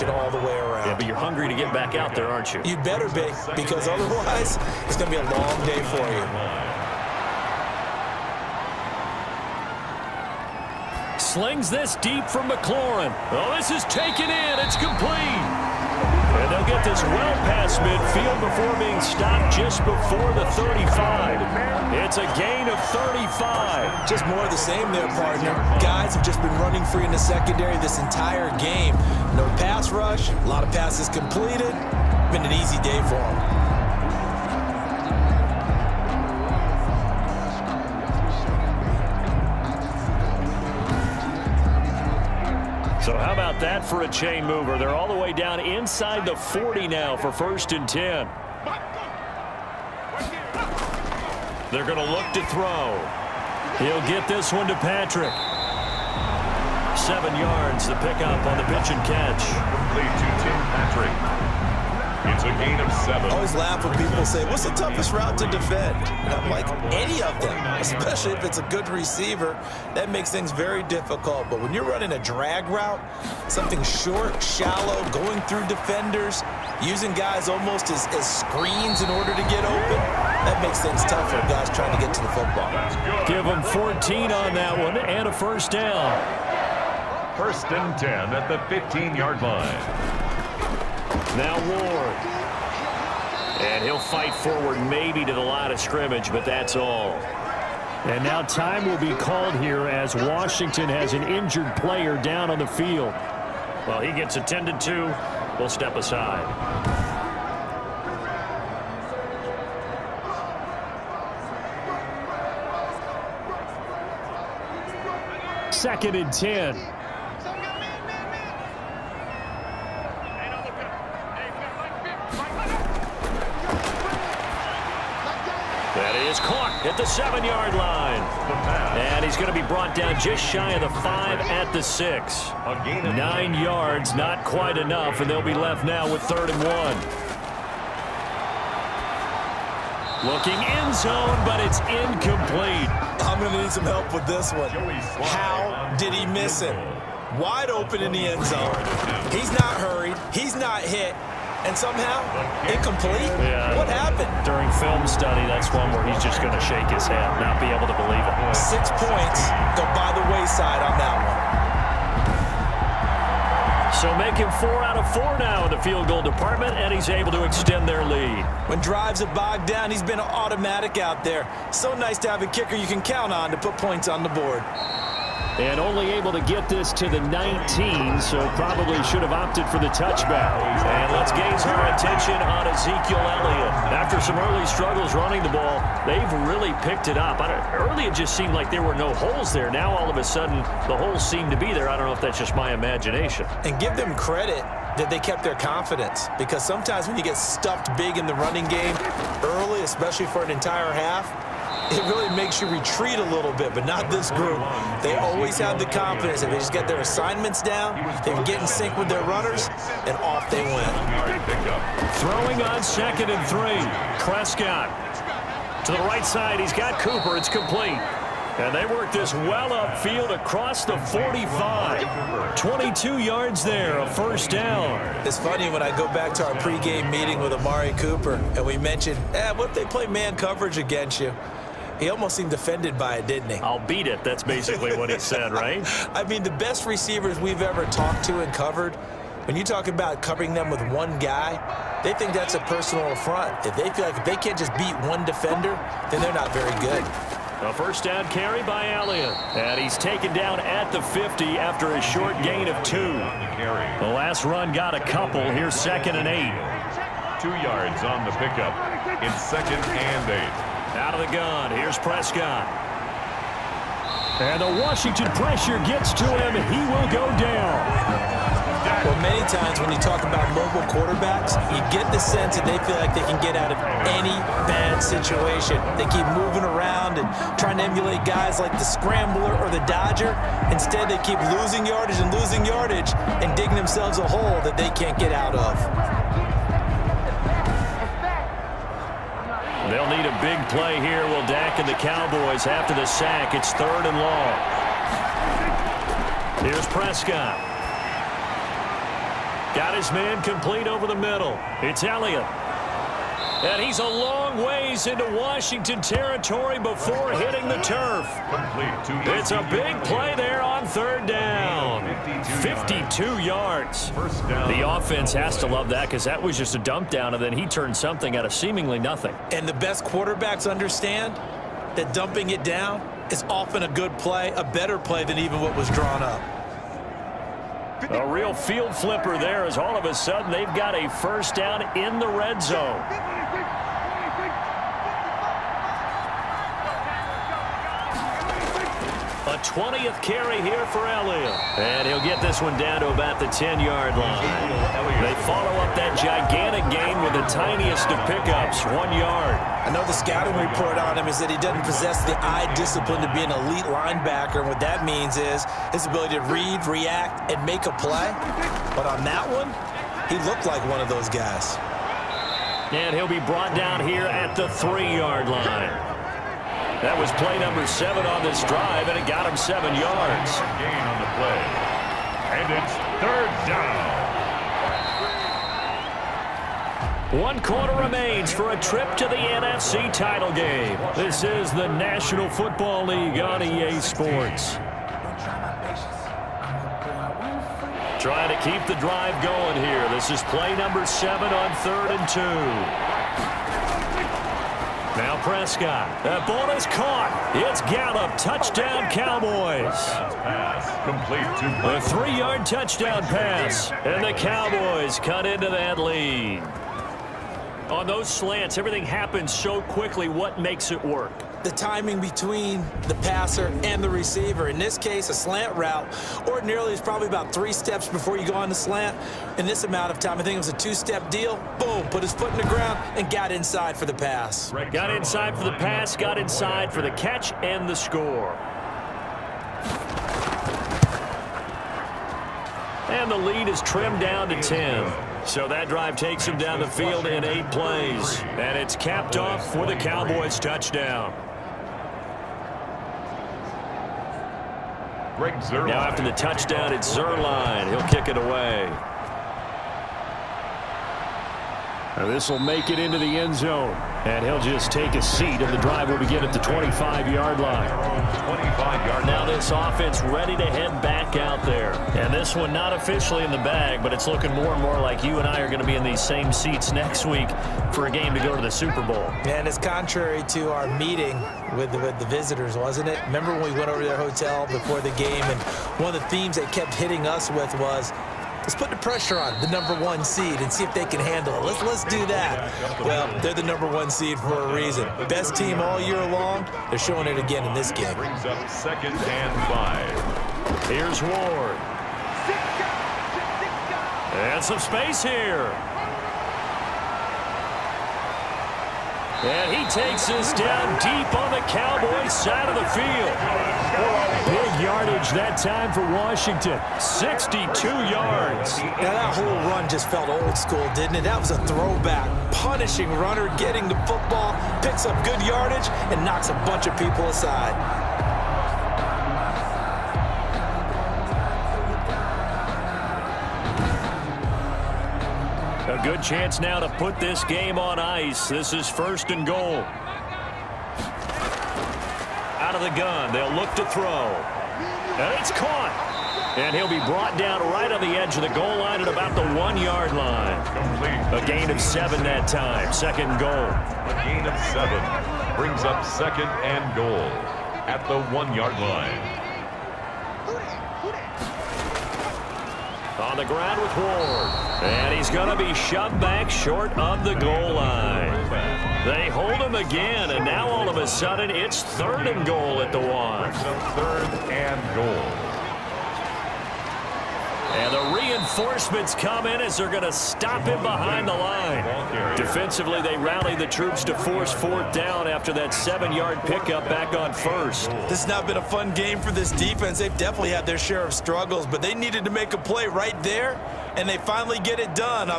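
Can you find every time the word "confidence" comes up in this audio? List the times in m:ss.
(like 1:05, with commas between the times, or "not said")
3:15, 3:25.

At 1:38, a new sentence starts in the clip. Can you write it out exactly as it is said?
And now time will be called here as Washington has an injured player down on the field.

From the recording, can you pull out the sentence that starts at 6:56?
Ordinarily, it's probably about three steps before you go on the slant.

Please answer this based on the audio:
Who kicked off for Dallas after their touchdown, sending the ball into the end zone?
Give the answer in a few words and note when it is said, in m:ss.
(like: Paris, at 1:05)
Zuerlein, at 7:27.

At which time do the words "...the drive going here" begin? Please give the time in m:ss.
6:28.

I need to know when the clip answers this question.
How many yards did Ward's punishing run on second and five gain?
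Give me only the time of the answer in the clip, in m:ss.
8:26.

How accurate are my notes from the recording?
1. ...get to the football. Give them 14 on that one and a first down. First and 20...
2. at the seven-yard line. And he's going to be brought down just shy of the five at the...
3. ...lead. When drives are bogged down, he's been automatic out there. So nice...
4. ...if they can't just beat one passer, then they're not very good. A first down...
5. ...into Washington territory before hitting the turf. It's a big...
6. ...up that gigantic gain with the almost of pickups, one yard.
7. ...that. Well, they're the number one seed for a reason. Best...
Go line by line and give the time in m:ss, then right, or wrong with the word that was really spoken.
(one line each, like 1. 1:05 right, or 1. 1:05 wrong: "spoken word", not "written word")
1. 1:22 wrong: "10", not "20"
2. 2:06 right
3. 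2:48 right
4. 4:04 wrong: "defender", not "passer"
5. 5:05 right
6. 5:45 wrong: "tiniest", not "almost"
7. 8:02 right.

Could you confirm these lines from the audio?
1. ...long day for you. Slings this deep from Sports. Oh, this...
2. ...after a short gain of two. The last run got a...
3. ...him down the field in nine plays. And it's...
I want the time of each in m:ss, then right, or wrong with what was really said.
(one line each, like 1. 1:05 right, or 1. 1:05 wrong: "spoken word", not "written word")
1. 0:05 wrong: "McLaurin", not "Sports"
2. 4:11 right
3. 7:16 wrong: "eight", not "nine".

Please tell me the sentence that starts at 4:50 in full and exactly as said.
They'll need a big play here.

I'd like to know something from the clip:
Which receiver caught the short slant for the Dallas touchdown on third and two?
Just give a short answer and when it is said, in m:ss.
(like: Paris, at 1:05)
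Gallup, at 6:37.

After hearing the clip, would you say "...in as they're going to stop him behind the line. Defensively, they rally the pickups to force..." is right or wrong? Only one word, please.
wrong.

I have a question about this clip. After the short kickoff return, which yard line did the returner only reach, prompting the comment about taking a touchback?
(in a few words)
19.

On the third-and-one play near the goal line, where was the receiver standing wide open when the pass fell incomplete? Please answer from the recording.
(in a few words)
In the end zone.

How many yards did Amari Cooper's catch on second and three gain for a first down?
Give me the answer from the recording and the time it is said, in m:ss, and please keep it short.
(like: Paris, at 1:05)
22, at 3:42.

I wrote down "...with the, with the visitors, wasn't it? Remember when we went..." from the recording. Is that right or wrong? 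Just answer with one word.
right.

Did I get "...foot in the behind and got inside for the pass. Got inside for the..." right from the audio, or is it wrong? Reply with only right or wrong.
wrong.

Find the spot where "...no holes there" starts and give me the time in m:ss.
3:08.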